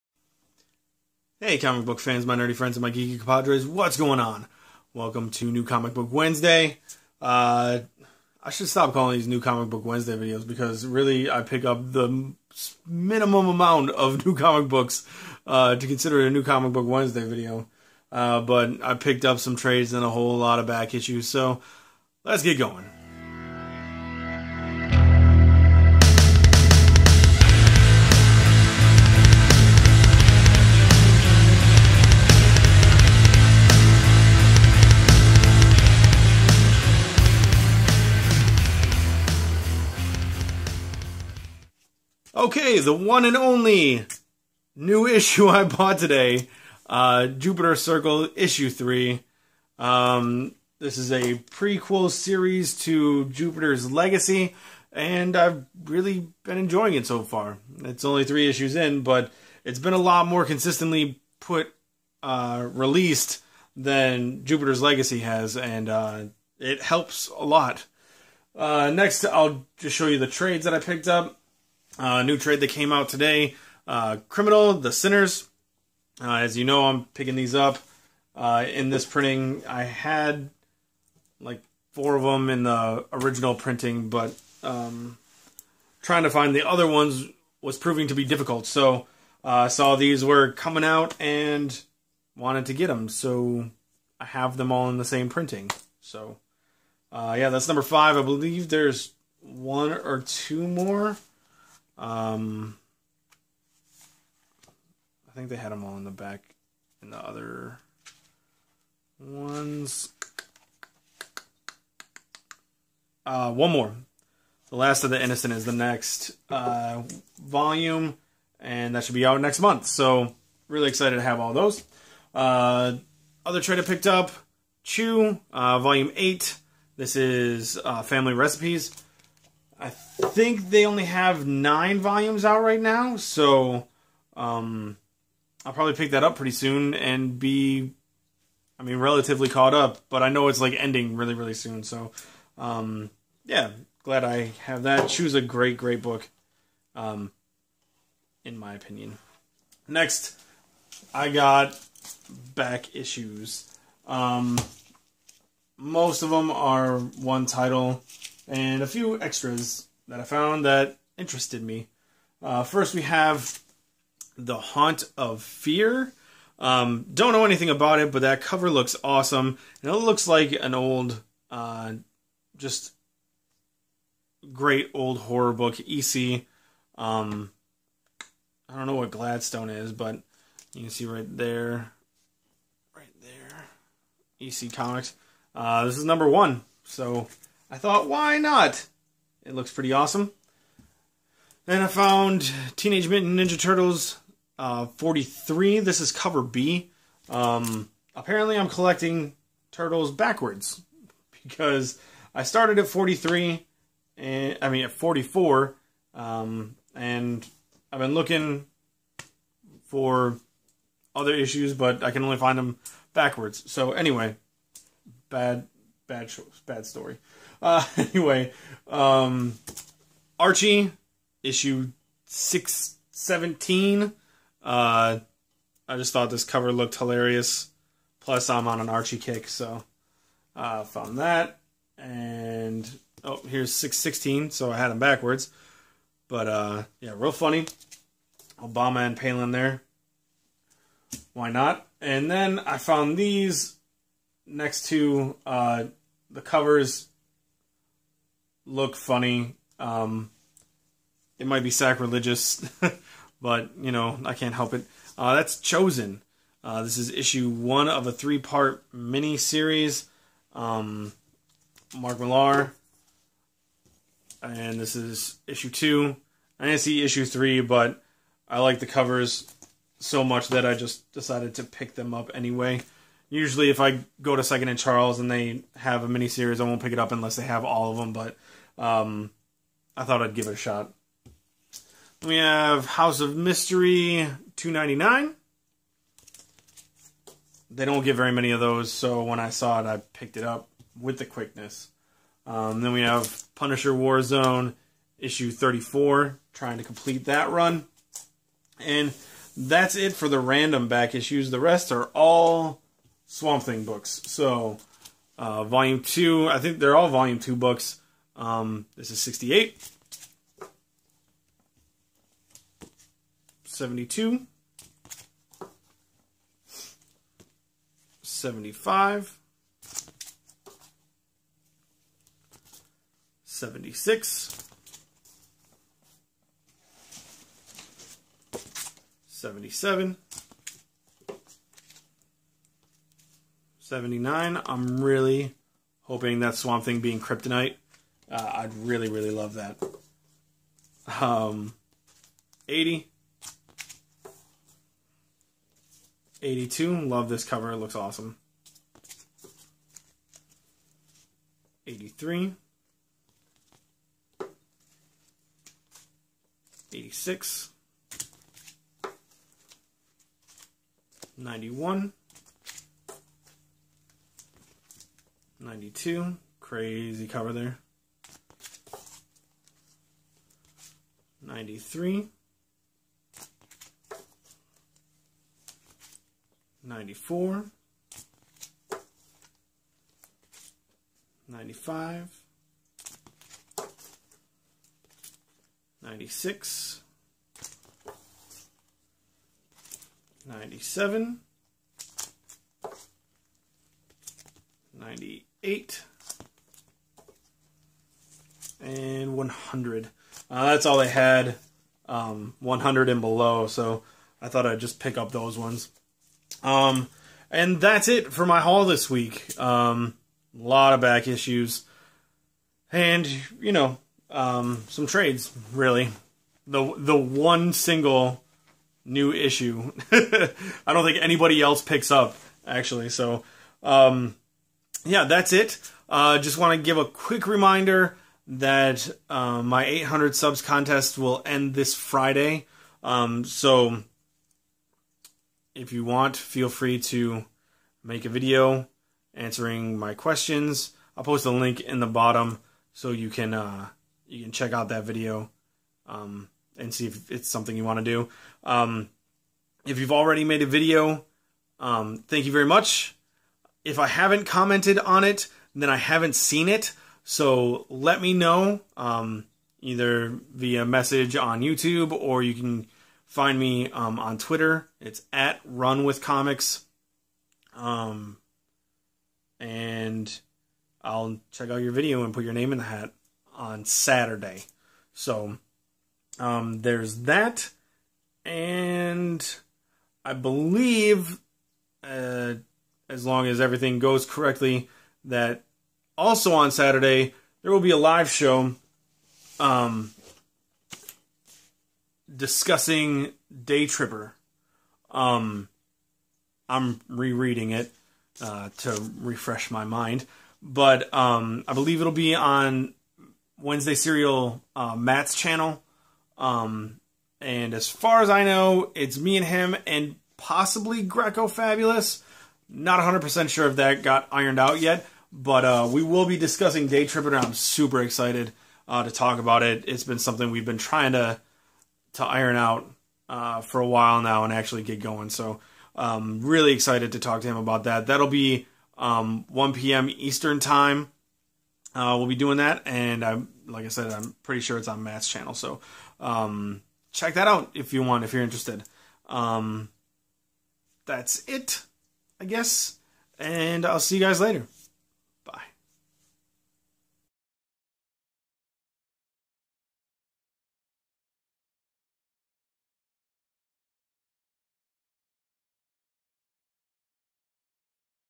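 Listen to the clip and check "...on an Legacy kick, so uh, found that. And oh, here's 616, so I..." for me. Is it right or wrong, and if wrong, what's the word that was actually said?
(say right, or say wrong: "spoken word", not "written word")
wrong: "Archie", not "Legacy".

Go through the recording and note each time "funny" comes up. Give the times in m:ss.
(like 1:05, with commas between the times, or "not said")
3:57, 4:08.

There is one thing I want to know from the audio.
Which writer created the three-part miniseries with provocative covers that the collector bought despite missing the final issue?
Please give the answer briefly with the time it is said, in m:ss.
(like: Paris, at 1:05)
Mark Millar, at 4:21.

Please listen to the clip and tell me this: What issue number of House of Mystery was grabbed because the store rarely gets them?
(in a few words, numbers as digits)
299.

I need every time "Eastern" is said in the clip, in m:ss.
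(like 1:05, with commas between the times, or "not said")
8:50.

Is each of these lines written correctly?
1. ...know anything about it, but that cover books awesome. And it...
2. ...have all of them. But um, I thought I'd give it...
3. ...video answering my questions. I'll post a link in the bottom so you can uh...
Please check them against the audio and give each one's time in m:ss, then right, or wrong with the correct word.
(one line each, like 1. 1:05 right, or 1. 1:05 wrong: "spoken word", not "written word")
1. 2:47 wrong: "looks", not "books"
2. 4:37 right
3. 7:18 right.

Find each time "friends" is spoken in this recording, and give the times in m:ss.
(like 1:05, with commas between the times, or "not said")
0:02.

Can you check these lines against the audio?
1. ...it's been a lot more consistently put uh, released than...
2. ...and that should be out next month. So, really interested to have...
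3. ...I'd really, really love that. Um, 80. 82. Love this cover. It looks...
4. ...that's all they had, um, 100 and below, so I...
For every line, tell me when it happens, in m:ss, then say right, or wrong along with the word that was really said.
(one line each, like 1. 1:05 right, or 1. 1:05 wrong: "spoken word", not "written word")
1. 0:59 right
2. 1:58 wrong: "excited", not "interested"
3. 5:38 right
4. 6:40 right.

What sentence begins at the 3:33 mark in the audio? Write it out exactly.
So anyway, bad, bad, bad story.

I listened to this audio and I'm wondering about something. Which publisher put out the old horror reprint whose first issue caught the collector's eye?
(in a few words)
EC Comics.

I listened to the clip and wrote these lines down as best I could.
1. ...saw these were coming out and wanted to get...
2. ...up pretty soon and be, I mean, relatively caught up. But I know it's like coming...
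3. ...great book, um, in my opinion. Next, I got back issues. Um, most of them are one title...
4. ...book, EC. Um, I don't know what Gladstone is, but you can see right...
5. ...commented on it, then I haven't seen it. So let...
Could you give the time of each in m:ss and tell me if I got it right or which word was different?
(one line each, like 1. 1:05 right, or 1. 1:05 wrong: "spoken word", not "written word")
1. 1:29 right
2. 2:16 wrong: "ending", not "coming"
3. 2:25 right
4. 2:55 right
5. 7:34 right.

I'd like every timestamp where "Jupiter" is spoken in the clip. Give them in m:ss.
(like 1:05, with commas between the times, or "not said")
0:47, 0:53, 1:04.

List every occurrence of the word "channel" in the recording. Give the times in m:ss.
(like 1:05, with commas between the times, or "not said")
8:25, 8:55.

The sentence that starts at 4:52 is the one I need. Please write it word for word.
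Um, then we have Punisher Warzone, issue 34, trying to complete that run.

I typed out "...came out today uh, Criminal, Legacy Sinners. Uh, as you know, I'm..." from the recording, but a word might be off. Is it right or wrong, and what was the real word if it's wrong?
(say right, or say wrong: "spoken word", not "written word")
wrong: "The", not "Legacy".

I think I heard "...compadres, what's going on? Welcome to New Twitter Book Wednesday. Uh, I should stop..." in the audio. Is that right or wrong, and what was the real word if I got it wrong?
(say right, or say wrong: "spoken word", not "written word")
wrong: "Comic", not "Twitter".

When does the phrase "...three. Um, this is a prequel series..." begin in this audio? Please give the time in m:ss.
0:48.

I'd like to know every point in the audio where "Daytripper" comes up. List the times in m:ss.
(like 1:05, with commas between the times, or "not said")
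8:13, 8:36.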